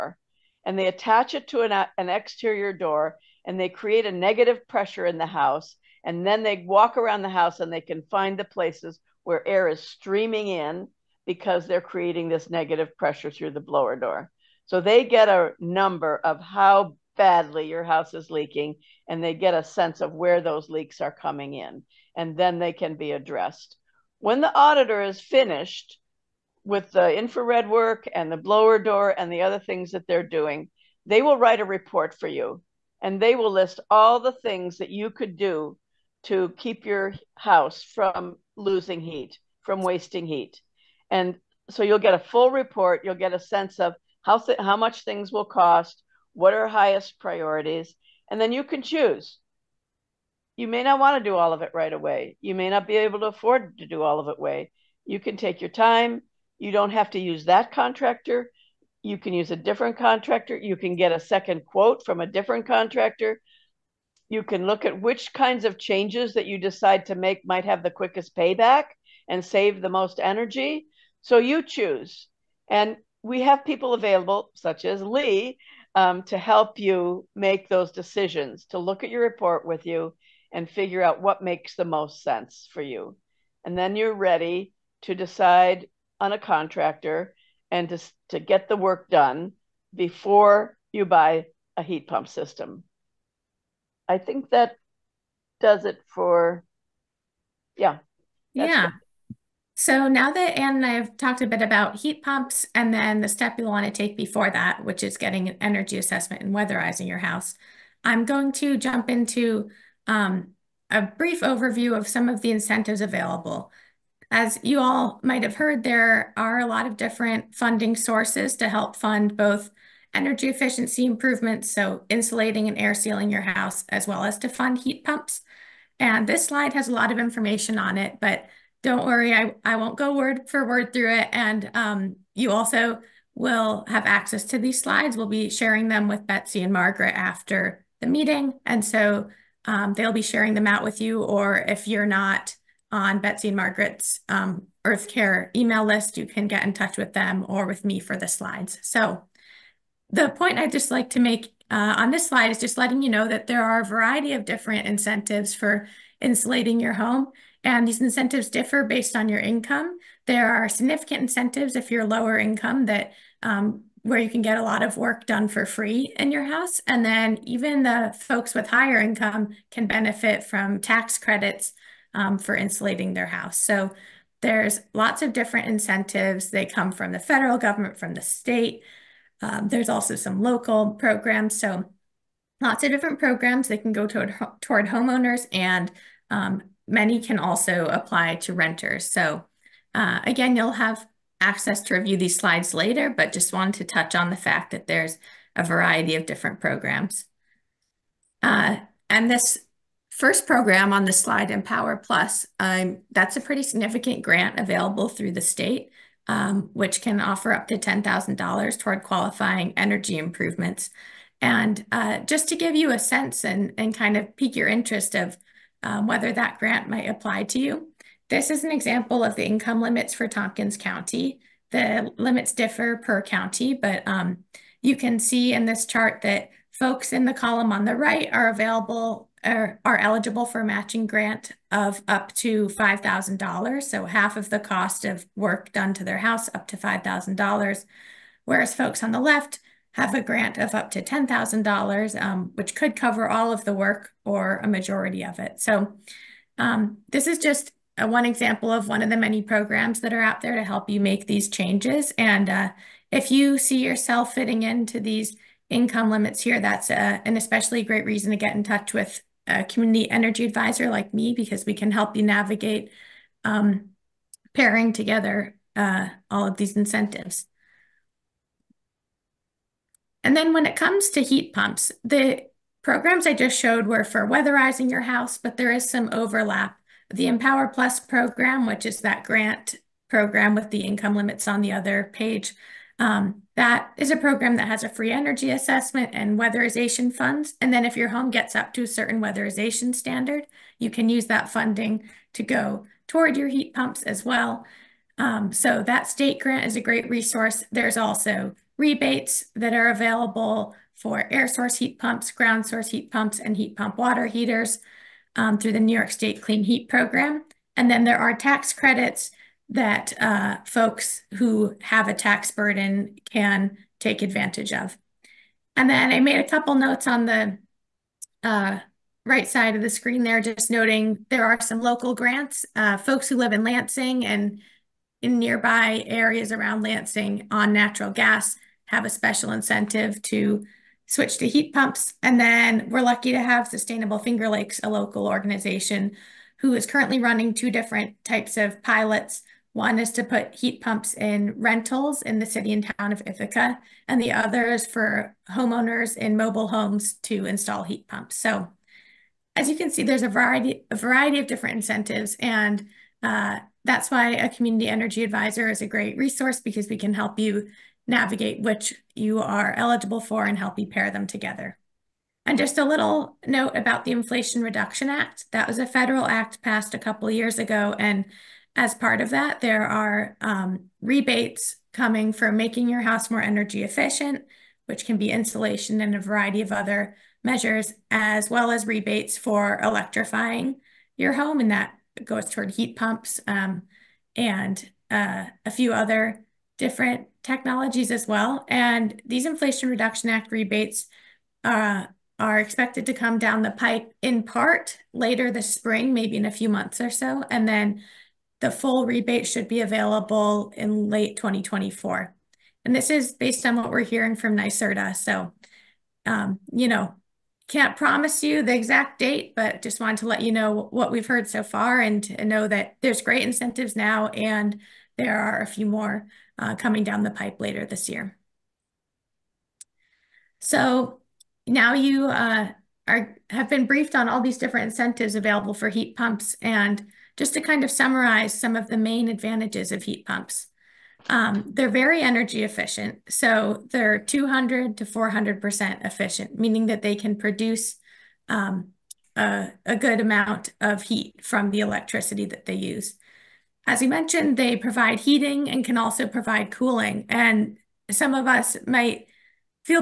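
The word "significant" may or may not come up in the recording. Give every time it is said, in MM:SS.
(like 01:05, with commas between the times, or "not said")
02:40, 03:23.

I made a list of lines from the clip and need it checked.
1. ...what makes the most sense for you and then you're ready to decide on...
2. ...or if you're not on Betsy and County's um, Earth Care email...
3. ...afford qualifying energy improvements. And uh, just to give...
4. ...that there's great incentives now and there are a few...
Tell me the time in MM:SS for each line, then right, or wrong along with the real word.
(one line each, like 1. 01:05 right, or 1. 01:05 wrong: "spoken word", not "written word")
1. 01:21 right
2. 02:21 wrong: "Margaret", not "County"
3. 03:28 wrong: "toward", not "afford"
4. 06:52 right.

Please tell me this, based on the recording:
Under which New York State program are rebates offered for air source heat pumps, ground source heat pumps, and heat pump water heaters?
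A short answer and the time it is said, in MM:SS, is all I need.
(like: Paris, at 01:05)
New York State Clean Heat Program, at 05:05.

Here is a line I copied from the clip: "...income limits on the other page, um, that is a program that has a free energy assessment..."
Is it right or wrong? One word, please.
right.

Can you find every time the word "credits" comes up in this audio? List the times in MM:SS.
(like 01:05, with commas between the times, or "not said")
02:51, 05:08.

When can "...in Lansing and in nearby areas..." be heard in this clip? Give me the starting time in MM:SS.
05:23.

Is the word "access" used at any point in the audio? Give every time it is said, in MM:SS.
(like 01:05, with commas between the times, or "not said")
02:14, 03:11.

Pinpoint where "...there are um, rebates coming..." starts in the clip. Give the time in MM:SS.
06:09.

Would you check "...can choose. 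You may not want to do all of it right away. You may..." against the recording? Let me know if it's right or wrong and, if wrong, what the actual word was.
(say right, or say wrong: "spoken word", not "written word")
right.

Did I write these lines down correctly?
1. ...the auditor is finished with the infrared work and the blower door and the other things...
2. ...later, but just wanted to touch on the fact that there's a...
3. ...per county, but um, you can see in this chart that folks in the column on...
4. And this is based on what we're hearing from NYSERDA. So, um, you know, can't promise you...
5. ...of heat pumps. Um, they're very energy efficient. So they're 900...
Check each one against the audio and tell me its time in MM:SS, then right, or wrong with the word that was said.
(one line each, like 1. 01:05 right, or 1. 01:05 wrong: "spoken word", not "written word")
1. 00:24 right
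2. 03:12 right
3. 03:42 right
4. 06:42 right
5. 07:09 wrong: "200", not "900".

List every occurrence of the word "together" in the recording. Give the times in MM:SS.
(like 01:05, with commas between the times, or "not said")
04:24, 06:01.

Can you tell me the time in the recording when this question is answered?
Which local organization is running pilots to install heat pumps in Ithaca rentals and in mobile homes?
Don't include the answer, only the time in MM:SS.
05:33.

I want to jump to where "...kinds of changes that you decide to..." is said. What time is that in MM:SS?
01:05.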